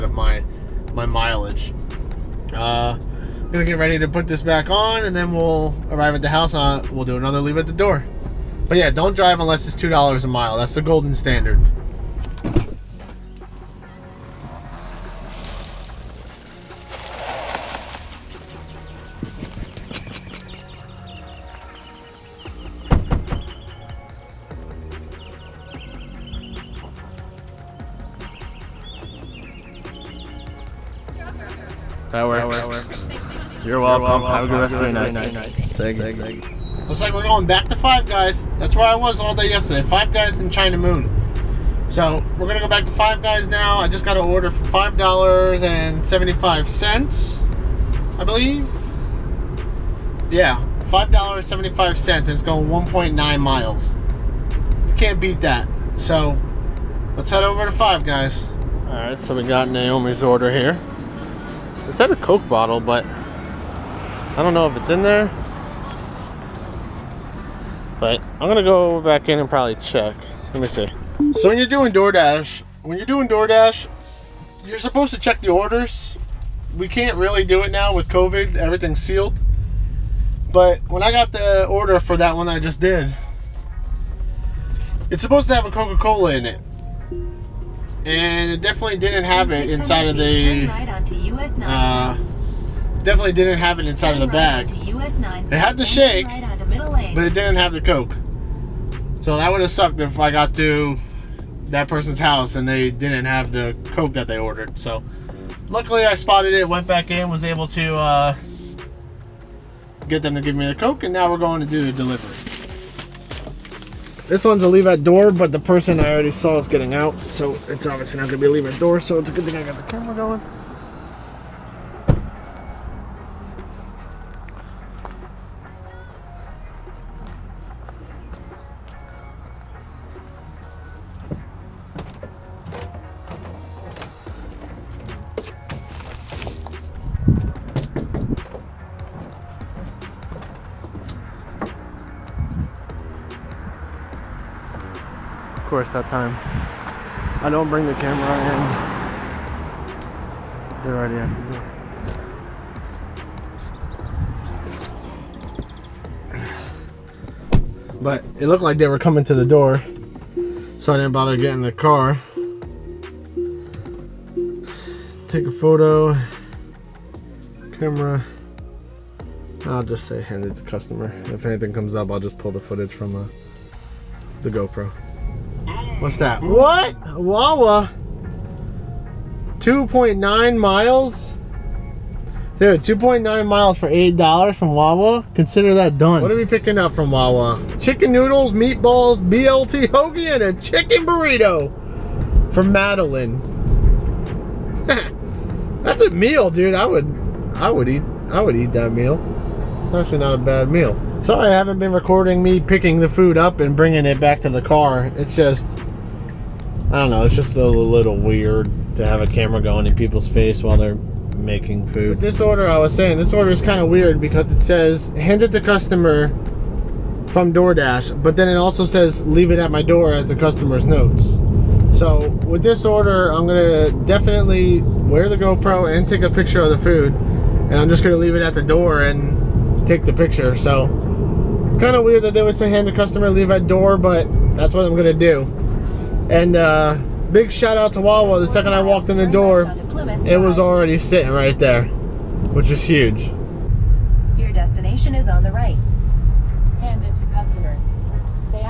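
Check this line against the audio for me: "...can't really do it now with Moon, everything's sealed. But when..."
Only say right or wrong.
wrong.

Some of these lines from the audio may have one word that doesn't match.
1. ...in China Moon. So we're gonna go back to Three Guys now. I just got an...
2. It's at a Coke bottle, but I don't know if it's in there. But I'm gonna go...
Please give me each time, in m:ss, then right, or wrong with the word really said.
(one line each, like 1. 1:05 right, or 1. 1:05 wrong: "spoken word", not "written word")
1. 0:40 wrong: "Five", not "Three"
2. 1:01 right.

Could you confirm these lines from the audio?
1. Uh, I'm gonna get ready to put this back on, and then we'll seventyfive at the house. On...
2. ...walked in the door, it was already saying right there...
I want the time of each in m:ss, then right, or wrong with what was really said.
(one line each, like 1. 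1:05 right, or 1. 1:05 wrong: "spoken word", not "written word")
1. 0:02 wrong: "arrive", not "seventyfive"
2. 3:58 wrong: "sitting", not "saying".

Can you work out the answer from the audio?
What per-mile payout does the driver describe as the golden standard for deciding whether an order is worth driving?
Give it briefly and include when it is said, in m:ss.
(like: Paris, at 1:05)
$2 a mile, at 0:09.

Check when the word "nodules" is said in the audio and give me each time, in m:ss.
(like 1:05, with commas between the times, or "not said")
not said.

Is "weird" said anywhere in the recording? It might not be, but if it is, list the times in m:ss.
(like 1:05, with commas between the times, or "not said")
3:28, 3:33, 3:52.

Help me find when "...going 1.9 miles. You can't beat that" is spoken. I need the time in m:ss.
0:52.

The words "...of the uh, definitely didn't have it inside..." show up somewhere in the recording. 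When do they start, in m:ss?
1:30.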